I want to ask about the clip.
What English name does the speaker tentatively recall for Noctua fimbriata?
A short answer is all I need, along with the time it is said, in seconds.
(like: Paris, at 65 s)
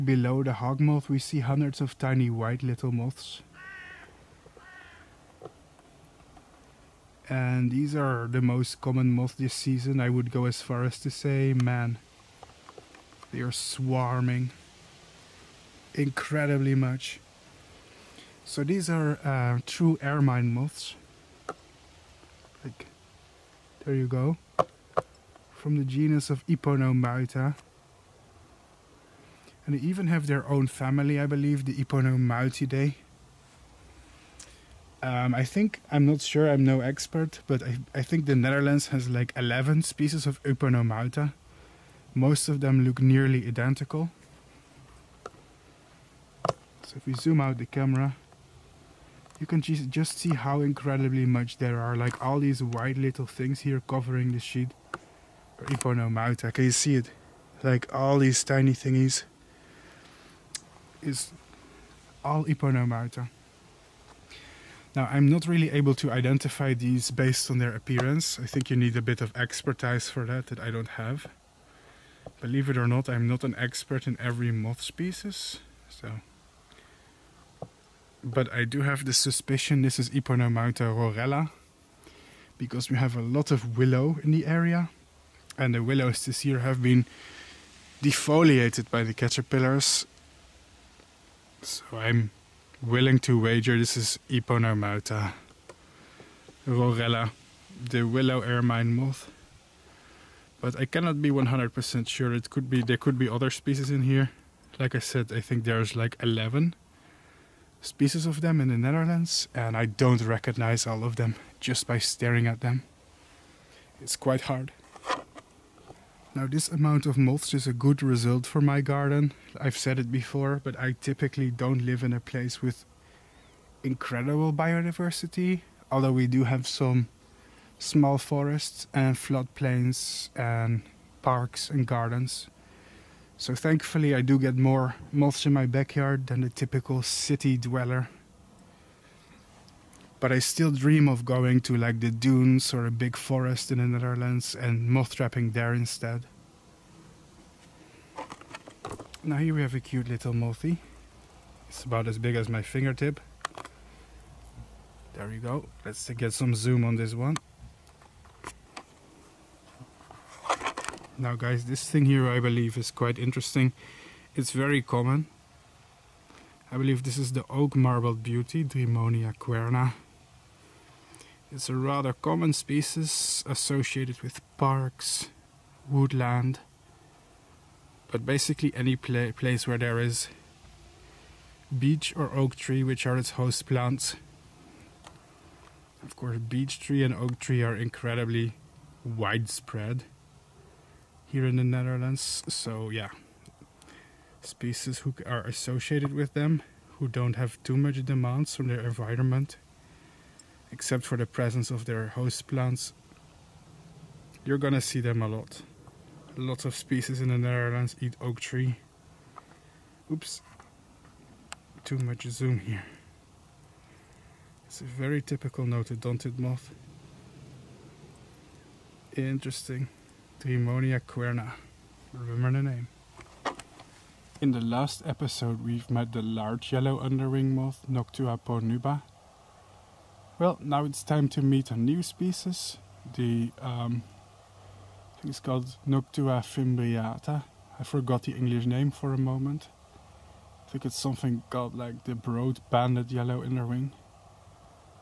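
broad banded yellow underwing, at 242 s.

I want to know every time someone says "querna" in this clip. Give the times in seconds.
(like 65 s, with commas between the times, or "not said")
169 s, 221 s.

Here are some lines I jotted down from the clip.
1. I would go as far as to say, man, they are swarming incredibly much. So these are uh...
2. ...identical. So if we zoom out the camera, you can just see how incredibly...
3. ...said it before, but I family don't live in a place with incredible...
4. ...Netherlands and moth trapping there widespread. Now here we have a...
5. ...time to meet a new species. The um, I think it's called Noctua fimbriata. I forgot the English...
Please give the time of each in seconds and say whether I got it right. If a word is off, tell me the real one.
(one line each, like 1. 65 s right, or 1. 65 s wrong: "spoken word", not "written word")
1. 9 s right
2. 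43 s right
3. 119 s wrong: "typically", not "family"
4. 143 s wrong: "instead", not "widespread"
5. 231 s right.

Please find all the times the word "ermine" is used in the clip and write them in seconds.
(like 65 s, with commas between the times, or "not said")
20 s, 98 s.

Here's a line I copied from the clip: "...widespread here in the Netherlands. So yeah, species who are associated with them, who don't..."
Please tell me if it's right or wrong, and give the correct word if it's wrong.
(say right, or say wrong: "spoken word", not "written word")
right.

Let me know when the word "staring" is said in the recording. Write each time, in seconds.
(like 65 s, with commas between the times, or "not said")
111 s.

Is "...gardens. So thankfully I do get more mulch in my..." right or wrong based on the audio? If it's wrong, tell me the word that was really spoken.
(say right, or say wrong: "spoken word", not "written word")
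right.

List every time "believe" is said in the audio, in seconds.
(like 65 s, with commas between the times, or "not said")
31 s, 72 s, 162 s, 166 s.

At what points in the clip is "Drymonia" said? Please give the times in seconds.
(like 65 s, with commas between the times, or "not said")
168 s, 220 s.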